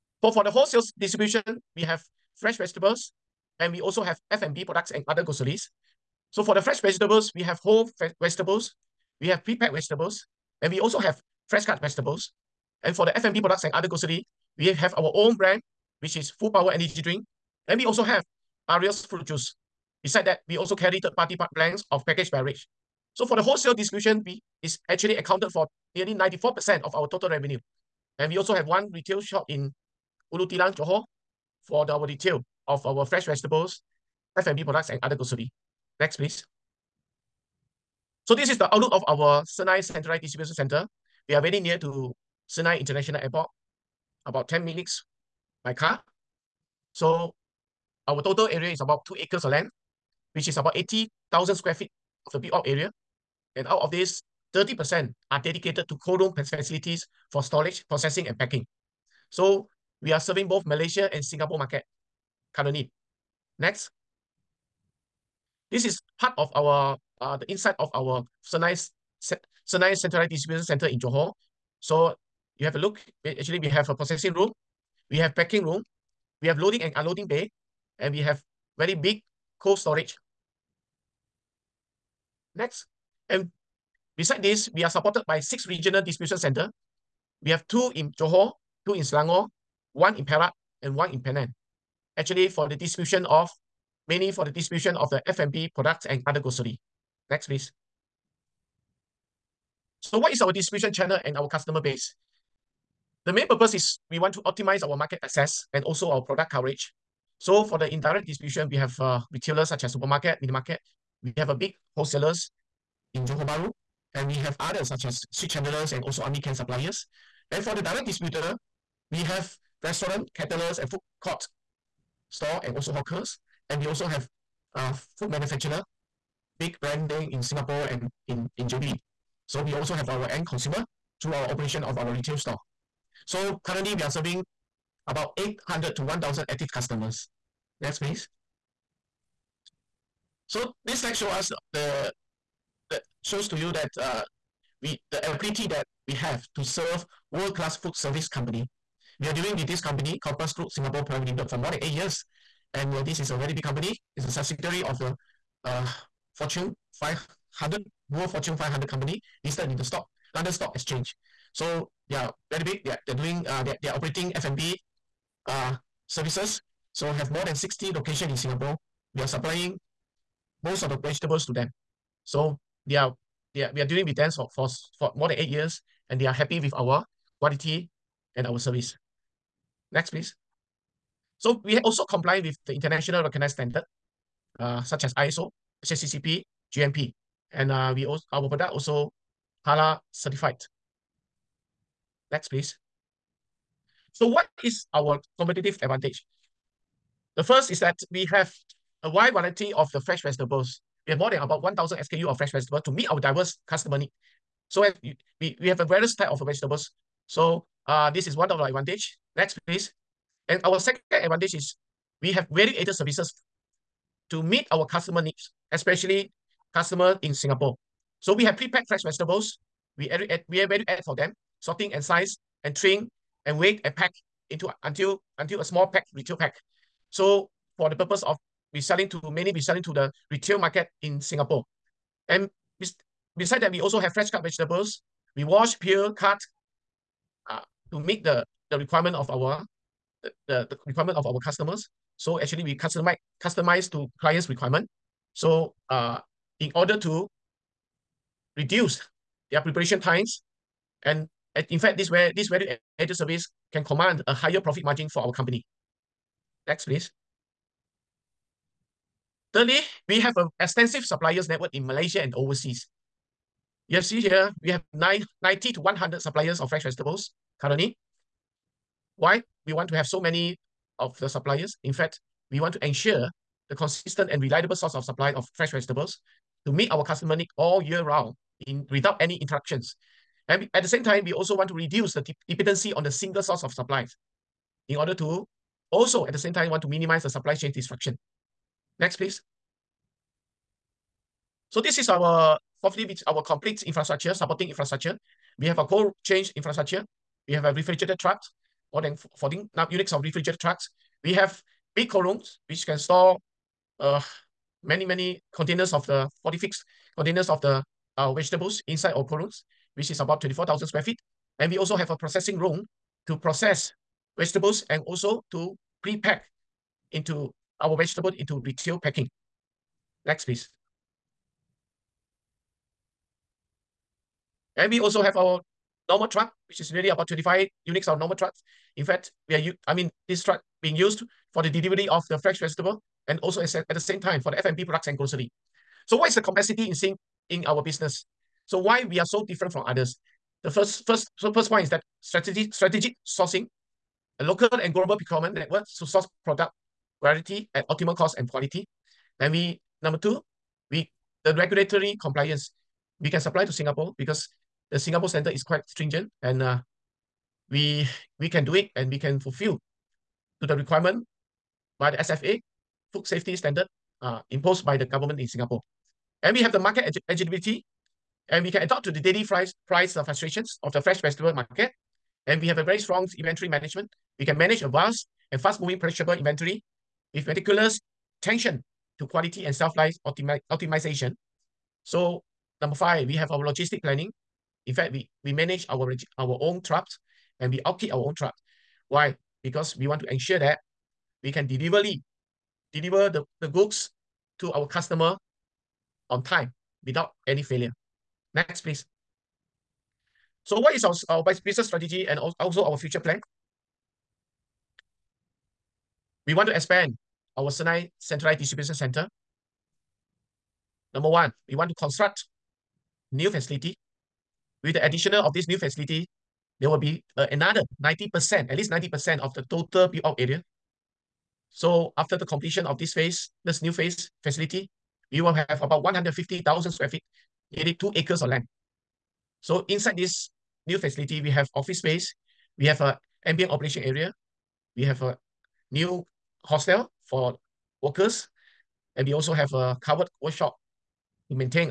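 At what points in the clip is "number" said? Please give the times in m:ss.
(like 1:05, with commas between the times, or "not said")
5:50, 6:22, 6:51.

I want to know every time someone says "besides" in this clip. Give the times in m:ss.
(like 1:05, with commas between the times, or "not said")
0:20, 1:24, 3:53.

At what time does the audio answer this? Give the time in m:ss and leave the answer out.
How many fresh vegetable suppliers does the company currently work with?
4:24.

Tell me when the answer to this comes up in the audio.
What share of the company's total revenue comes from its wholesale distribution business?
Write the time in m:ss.
0:25.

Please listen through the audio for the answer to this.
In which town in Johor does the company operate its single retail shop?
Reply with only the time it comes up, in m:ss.
0:30.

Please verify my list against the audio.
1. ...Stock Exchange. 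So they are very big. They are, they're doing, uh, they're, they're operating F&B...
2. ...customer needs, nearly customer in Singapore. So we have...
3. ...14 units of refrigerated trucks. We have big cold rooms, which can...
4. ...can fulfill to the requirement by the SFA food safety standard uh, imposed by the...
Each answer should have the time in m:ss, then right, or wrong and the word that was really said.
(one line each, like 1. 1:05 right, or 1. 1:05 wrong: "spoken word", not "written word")
1. 2:40 right
2. 3:34 wrong: "especially", not "nearly"
3. 4:59 right
4. 5:59 right.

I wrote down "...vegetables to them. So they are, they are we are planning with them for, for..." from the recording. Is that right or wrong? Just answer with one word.
wrong.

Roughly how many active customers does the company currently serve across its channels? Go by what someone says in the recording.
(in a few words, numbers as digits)
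800 to 1,000.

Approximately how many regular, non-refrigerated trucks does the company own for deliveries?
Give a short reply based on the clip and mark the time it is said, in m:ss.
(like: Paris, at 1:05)
25, at 5:27.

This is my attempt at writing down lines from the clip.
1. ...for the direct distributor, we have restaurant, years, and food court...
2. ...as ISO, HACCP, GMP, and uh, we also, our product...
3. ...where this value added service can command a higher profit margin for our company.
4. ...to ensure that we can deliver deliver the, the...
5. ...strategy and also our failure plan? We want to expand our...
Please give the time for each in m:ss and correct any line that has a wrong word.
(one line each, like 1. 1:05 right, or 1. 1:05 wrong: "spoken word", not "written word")
1. 1:57 wrong: "caterers", not "years"
2. 3:05 right
3. 4:12 right
4. 6:30 right
5. 6:41 wrong: "future", not "failure".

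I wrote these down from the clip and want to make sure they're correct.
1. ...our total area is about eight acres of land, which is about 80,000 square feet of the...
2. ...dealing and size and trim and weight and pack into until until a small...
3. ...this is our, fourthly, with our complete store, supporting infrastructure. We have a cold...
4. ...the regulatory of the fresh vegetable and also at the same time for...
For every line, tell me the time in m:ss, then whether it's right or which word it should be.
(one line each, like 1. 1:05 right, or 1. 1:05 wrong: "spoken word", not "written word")
1. 0:48 wrong: "two", not "eight"
2. 3:41 wrong: "sorting", not "dealing"
3. 4:51 wrong: "infrastructure", not "store"
4. 5:31 wrong: "delivery", not "regulatory".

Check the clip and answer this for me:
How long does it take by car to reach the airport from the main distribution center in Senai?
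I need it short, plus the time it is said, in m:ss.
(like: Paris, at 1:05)
10 minutes, at 0:44.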